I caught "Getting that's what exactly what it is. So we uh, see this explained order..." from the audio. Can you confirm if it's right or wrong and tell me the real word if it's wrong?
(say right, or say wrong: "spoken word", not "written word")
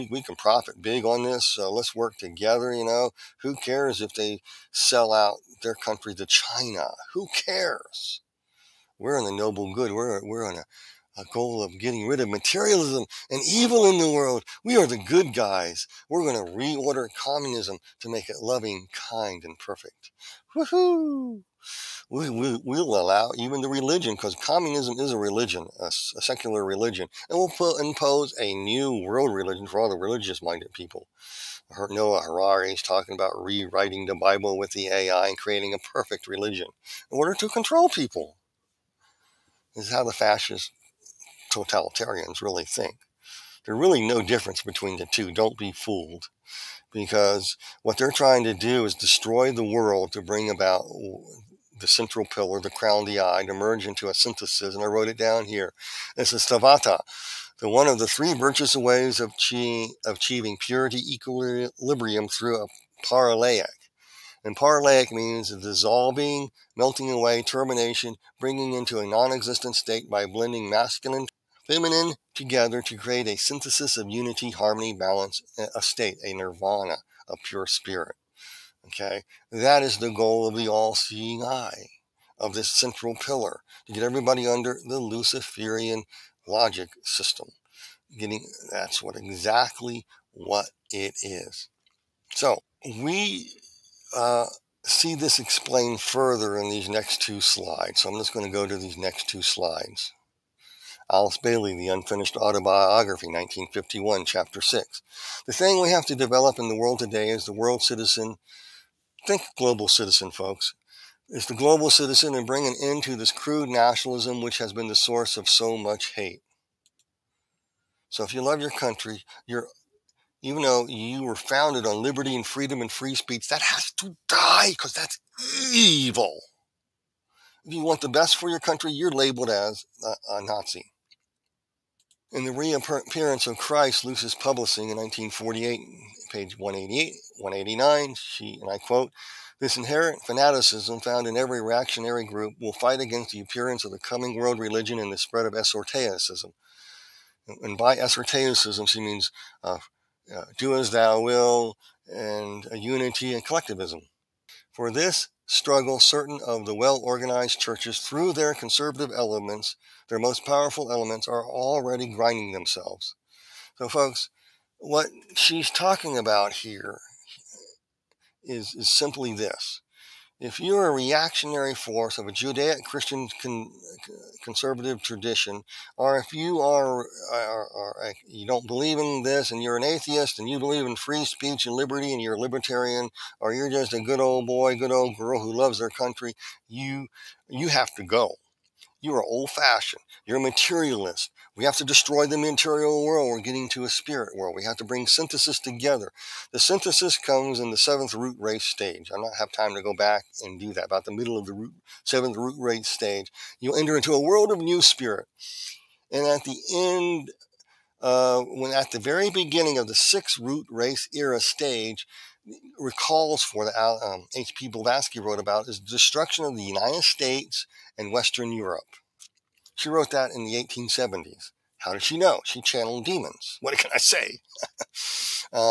wrong: "further", not "order".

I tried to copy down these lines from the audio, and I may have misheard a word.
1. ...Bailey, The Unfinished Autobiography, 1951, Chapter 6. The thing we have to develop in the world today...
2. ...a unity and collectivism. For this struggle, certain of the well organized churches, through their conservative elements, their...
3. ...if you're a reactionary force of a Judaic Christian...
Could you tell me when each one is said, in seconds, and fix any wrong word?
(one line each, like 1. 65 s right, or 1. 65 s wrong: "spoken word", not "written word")
1. 101 s right
2. 152 s right
3. 170 s right.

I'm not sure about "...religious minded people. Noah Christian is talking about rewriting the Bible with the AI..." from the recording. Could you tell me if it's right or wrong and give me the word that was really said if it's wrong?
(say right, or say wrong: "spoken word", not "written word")
wrong: "Harari", not "Christian".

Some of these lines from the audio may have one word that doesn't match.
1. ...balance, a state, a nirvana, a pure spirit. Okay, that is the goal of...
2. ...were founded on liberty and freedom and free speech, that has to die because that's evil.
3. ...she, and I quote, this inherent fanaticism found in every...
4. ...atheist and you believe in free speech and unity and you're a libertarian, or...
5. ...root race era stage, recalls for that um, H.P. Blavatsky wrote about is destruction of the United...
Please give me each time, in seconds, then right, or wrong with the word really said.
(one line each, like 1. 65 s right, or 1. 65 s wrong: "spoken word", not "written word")
1. 74 s right
2. 121 s right
3. 138 s right
4. 179 s wrong: "liberty", not "unity"
5. 210 s right.